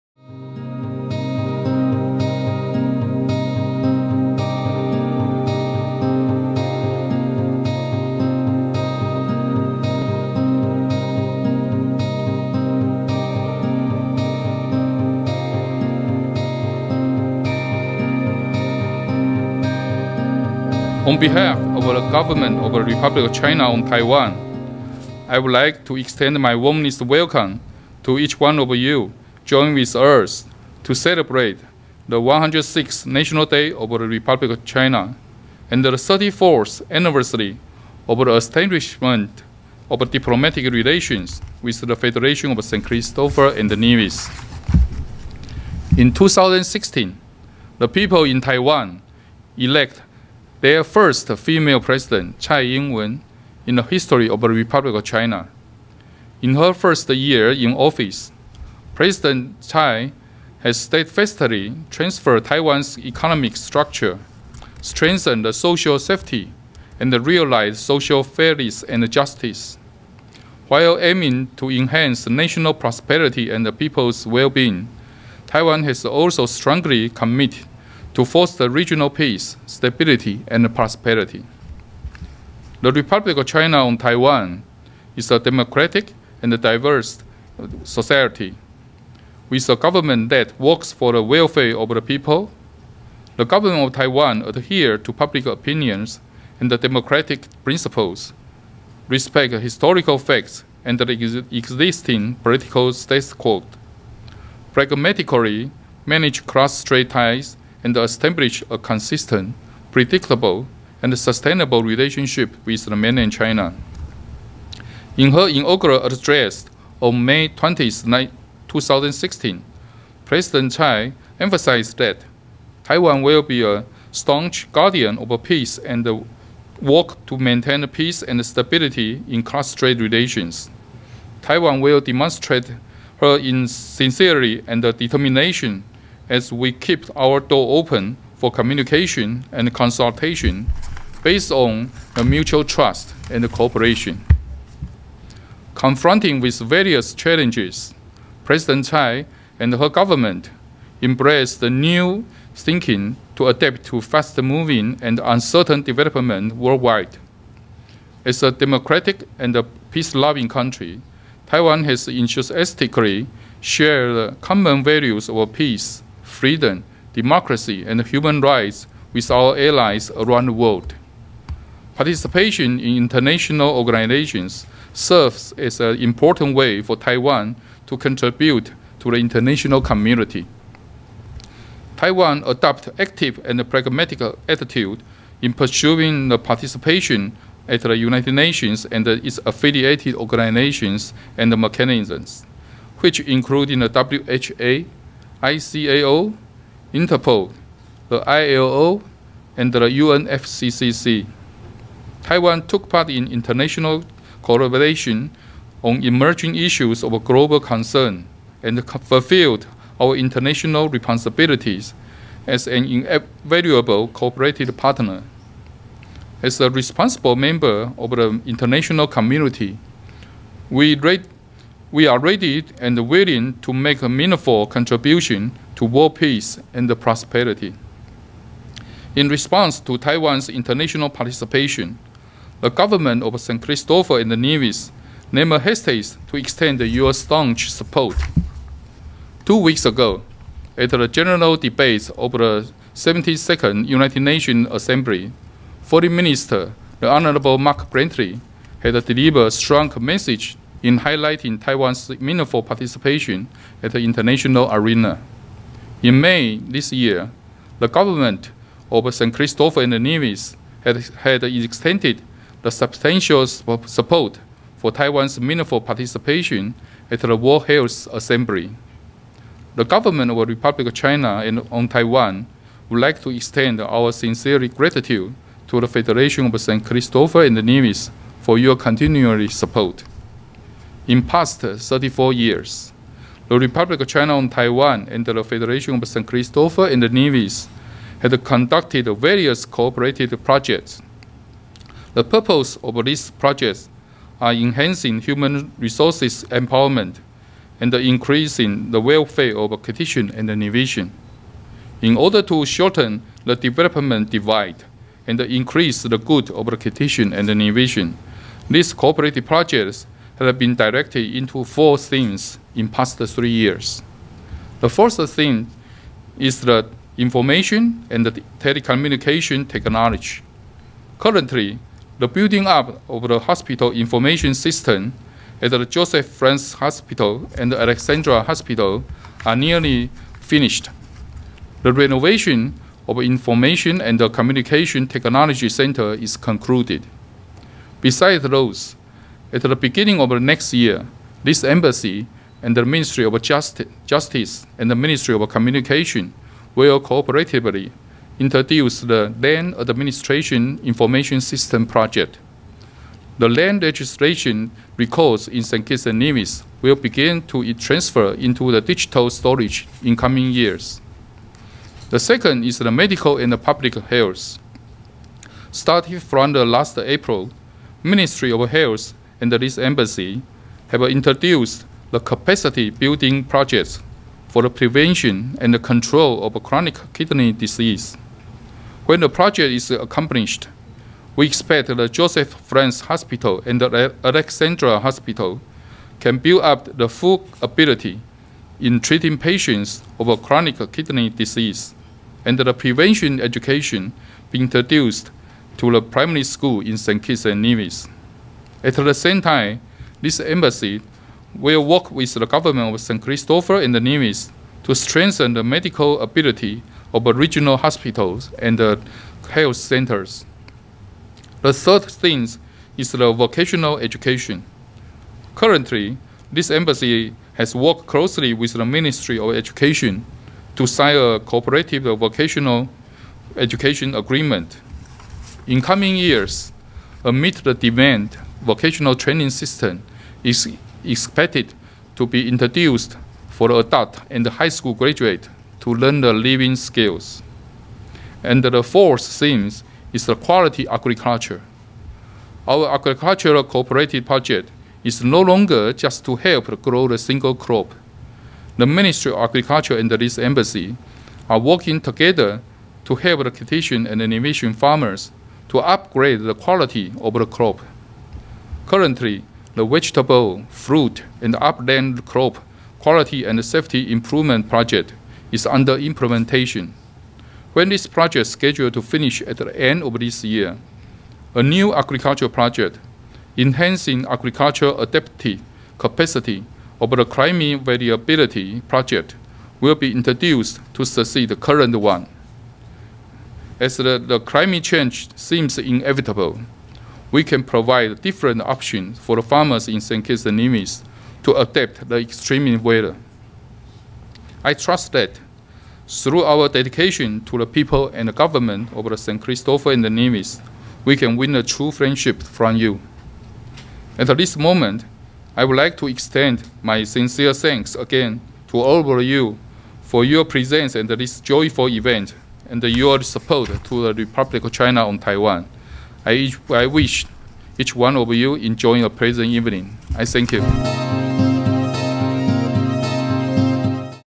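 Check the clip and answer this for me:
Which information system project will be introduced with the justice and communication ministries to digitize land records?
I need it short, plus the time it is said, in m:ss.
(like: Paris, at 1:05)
Land Administration Information System, at 5:49.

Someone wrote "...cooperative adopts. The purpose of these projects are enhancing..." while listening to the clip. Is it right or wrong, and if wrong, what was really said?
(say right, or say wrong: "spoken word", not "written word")
wrong: "projects", not "adopts".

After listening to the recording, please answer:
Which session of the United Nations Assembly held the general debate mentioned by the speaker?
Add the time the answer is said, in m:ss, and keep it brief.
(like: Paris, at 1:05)
72nd, at 4:02.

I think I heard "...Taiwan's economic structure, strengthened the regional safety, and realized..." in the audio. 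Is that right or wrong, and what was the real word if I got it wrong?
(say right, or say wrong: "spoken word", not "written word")
wrong: "social", not "regional".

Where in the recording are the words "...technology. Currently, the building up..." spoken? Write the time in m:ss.
5:19.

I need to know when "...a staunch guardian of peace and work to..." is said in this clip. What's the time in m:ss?
2:03.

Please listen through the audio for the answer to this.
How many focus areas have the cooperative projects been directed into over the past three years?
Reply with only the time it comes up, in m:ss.
5:11.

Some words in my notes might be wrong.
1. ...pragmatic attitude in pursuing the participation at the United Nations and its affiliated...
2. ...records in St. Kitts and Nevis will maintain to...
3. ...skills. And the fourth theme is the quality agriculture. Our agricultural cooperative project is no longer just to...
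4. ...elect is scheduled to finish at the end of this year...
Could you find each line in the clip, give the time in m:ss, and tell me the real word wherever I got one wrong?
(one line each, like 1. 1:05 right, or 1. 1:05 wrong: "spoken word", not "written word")
1. 3:03 right
2. 5:54 wrong: "begin", not "maintain"
3. 7:16 right
4. 7:48 wrong: "project", not "elect".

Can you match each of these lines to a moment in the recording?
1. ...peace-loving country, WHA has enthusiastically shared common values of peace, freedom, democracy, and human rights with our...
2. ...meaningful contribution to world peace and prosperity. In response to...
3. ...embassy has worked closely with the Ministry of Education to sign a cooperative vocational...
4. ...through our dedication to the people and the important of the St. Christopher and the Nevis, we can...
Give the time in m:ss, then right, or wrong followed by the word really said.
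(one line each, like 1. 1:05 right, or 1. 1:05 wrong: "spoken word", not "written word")
1. 2:39 wrong: "Taiwan", not "WHA"
2. 3:44 right
3. 6:56 right
4. 8:16 wrong: "government", not "important".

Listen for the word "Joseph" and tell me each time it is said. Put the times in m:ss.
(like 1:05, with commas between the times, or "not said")
5:25, 6:22.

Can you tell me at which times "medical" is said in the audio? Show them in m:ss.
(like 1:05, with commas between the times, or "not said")
6:02, 6:45.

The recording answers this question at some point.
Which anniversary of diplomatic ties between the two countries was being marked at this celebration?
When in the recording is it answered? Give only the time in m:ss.
0:35.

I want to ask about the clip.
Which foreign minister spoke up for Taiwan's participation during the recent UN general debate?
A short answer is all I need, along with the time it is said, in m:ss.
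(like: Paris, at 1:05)
Mark Brantley, at 4:07.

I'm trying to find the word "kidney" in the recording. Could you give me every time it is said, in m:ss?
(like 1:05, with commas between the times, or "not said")
6:17, 6:30.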